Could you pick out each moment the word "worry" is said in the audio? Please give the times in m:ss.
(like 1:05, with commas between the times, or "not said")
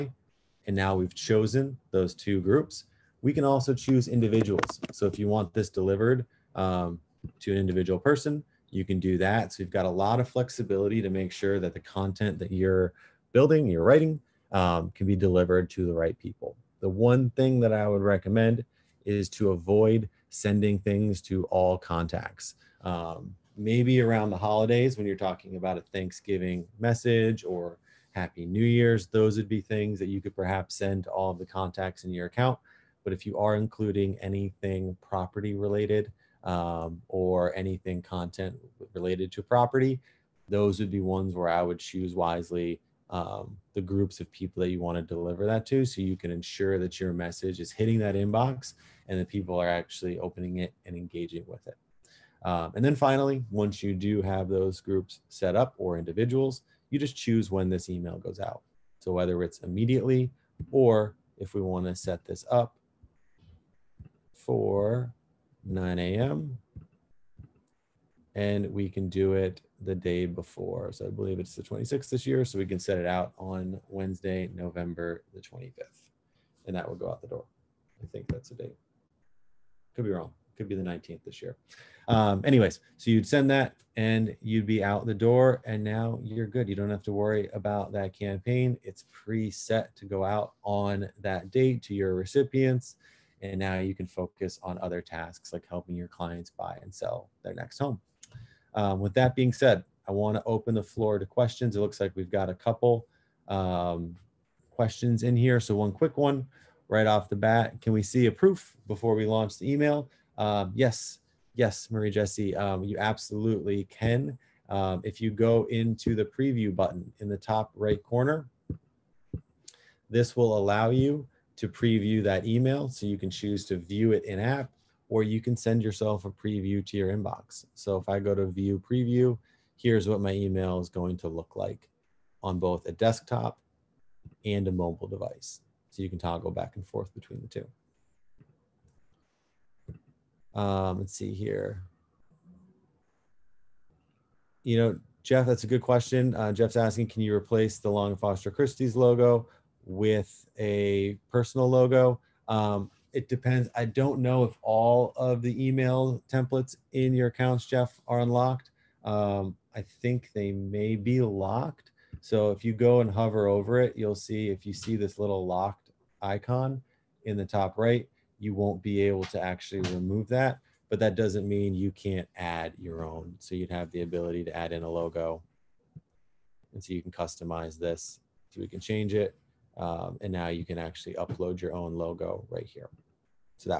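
1:27.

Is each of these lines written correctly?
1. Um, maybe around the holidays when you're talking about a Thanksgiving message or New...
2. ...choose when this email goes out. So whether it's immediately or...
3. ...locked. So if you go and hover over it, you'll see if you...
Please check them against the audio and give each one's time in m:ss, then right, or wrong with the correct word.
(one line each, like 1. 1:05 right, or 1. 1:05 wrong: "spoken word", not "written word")
1. 0:22 wrong: "Happy", not "New"
2. 0:57 right
3. 2:41 right.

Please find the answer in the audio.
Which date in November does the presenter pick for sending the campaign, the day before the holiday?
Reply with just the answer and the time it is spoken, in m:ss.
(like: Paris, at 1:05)
November 25, at 1:14.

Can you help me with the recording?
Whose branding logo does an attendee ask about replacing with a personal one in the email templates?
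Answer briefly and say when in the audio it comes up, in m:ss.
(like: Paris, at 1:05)
Long Foster Christie's, at 2:27.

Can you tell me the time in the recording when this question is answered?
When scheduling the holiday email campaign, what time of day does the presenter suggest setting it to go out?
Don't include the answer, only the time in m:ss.
1:05.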